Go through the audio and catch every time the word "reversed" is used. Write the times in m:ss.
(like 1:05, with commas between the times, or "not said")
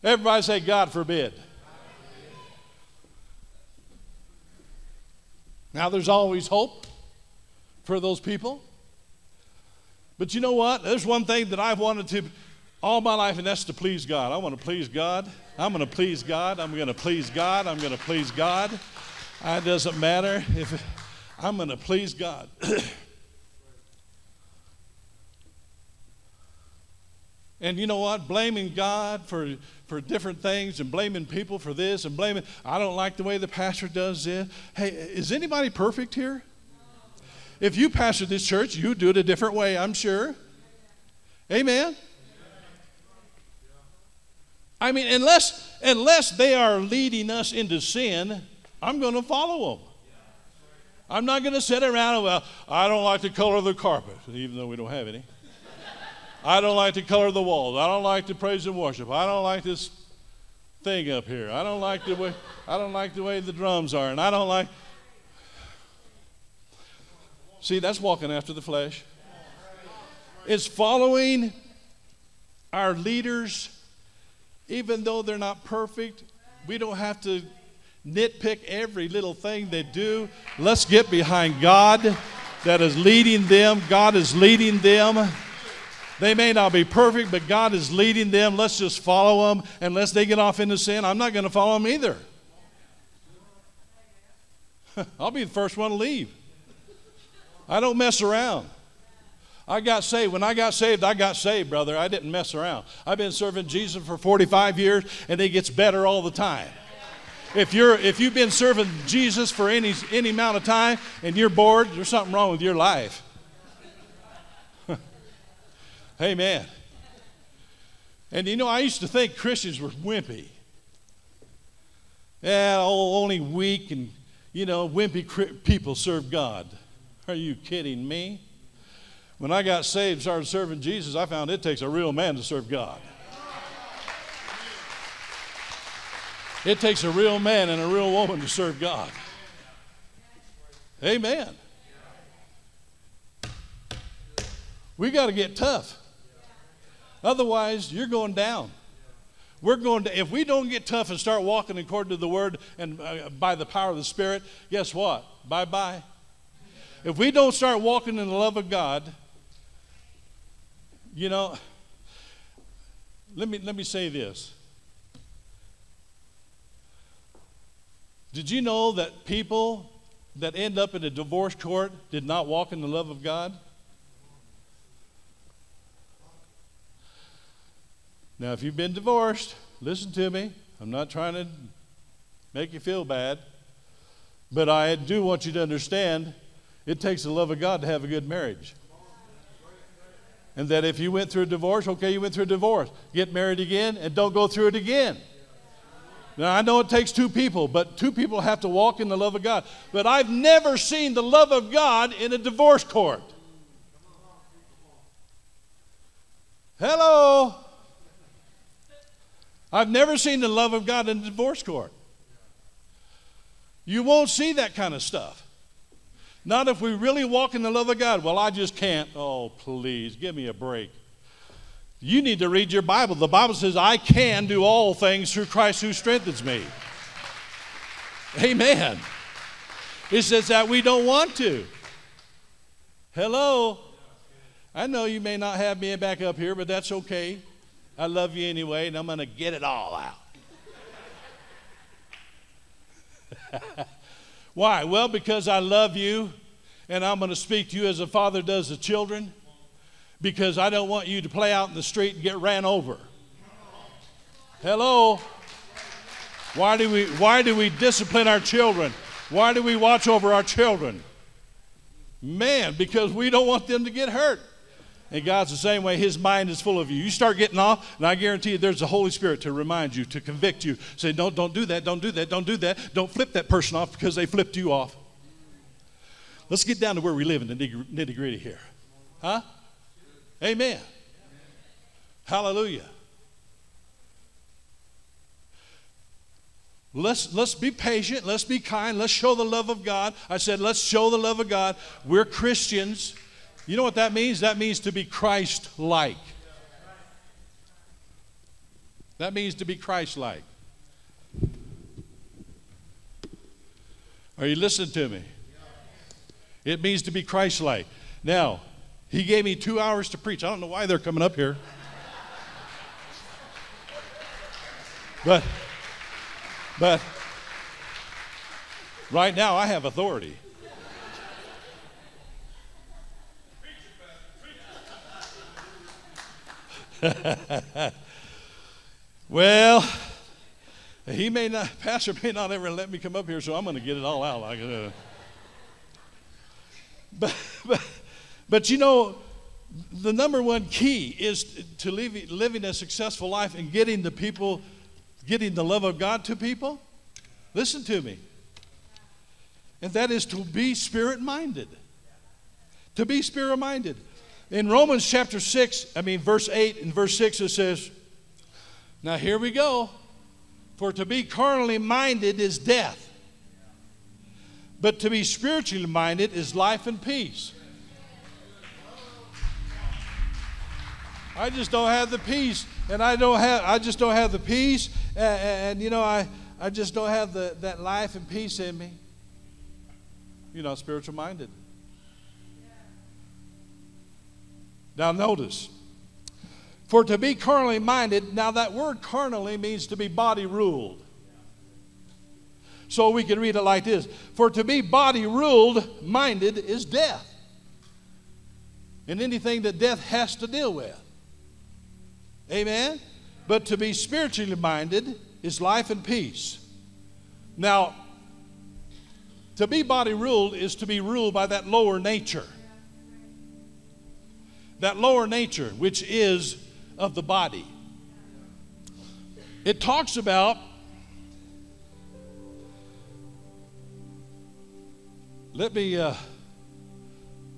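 not said.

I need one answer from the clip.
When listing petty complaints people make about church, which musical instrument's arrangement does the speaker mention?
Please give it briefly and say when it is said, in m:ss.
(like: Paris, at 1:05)
drums, at 1:03.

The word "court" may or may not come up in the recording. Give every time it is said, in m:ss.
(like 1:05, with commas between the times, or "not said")
2:51, 3:22, 3:31.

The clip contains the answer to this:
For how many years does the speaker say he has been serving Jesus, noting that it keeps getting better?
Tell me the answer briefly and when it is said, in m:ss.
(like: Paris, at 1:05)
45, at 1:44.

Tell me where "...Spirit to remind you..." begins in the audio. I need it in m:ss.
4:29.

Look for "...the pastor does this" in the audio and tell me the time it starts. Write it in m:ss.
0:33.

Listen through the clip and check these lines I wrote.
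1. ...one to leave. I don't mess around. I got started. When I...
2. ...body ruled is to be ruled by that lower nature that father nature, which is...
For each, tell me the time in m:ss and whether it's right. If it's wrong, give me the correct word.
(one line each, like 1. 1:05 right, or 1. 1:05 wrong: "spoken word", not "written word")
1. 1:35 wrong: "saved", not "started"
2. 6:49 wrong: "lower", not "father".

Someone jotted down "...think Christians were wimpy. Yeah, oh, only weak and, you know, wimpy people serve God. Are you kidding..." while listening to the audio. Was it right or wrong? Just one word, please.
right.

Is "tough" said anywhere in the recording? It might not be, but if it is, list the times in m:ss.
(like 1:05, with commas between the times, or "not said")
2:25, 2:30.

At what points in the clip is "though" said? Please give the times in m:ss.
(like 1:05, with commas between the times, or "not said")
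0:54, 1:15.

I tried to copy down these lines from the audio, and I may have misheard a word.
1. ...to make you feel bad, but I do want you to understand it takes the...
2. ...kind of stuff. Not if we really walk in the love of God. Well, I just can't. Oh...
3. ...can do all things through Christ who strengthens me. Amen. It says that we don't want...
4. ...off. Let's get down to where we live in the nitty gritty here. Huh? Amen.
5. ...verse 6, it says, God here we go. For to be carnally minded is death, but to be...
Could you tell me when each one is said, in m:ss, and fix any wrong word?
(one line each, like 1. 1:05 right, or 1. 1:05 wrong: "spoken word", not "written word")
1. 3:01 right
2. 3:34 right
3. 3:43 right
4. 4:34 right
5. 5:56 wrong: "Now", not "God".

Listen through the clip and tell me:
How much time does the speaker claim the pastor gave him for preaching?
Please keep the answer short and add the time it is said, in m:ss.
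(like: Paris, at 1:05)
two hours, at 5:09.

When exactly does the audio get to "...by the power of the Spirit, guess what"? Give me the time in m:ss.
2:33.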